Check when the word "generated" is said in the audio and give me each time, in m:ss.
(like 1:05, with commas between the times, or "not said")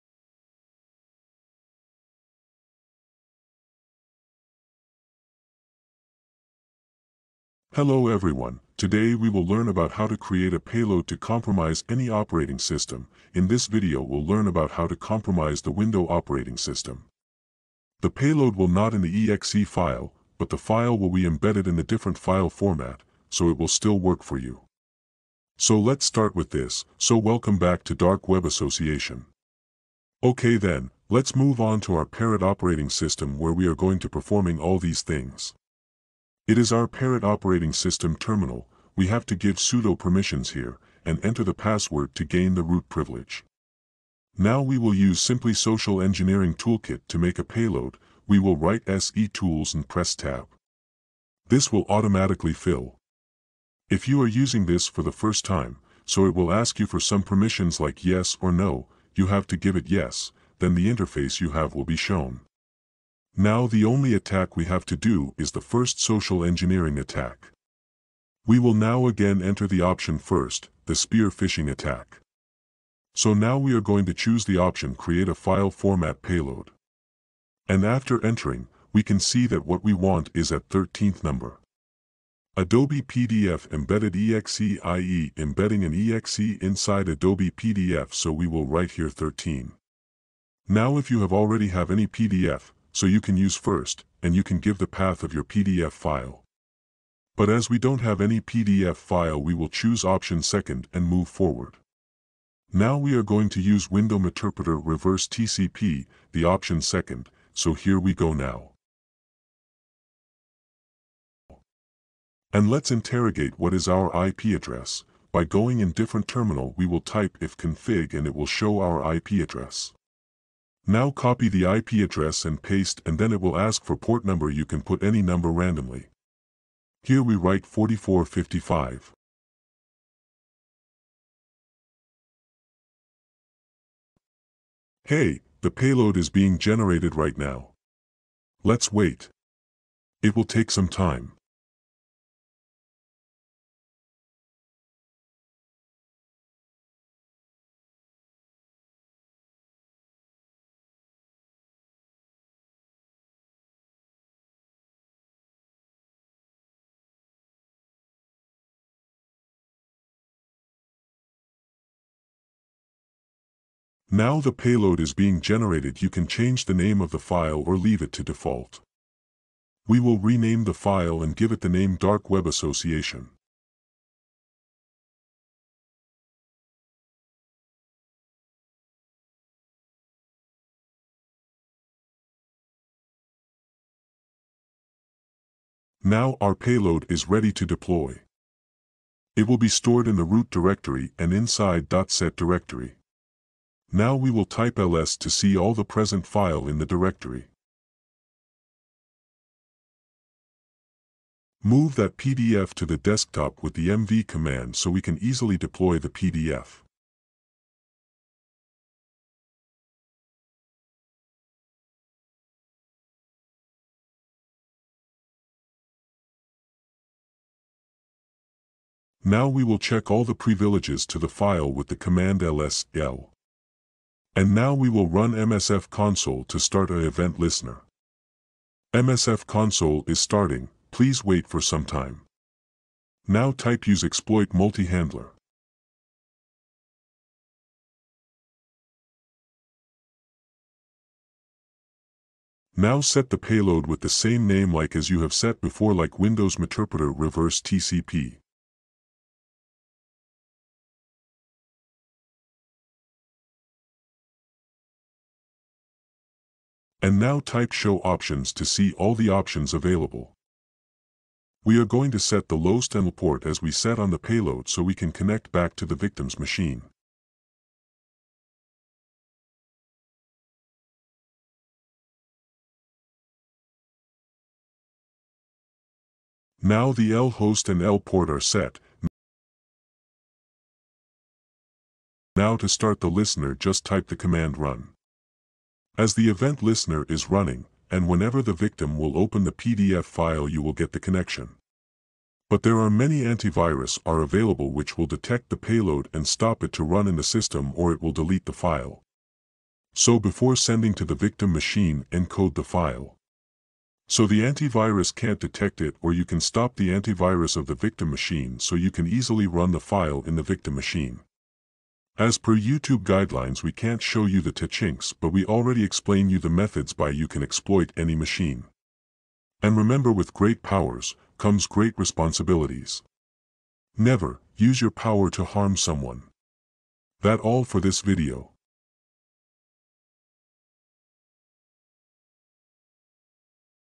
2:16, 2:45.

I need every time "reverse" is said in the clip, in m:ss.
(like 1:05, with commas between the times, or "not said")
1:44, 4:07.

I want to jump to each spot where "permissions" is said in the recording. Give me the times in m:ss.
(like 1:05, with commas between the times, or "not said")
0:39, 0:57.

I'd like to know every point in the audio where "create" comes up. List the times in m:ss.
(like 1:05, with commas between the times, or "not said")
0:10, 1:14.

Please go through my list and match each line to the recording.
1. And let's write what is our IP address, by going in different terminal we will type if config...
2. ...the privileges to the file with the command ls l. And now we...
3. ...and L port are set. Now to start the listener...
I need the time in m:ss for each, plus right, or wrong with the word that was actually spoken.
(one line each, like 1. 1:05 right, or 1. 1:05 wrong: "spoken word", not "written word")
1. 1:52 wrong: "interrogate", not "write"
2. 3:40 right
3. 4:37 right.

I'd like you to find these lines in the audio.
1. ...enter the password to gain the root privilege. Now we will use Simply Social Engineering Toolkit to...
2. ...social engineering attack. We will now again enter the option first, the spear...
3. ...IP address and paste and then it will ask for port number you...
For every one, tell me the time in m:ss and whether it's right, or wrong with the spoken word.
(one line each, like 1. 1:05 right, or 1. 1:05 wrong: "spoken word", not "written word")
1. 0:41 right
2. 1:06 right
3. 2:01 right.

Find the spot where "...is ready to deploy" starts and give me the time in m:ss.
3:07.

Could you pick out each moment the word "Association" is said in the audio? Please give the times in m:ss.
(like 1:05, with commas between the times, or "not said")
0:28, 2:52.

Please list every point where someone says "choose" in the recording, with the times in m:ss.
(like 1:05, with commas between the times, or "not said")
1:14, 1:39.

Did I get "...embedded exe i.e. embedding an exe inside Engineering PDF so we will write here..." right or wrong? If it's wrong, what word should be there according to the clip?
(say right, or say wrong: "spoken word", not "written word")
wrong: "Adobe", not "Engineering".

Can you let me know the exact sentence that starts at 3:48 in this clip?
MSF console is starting, please wait for some time.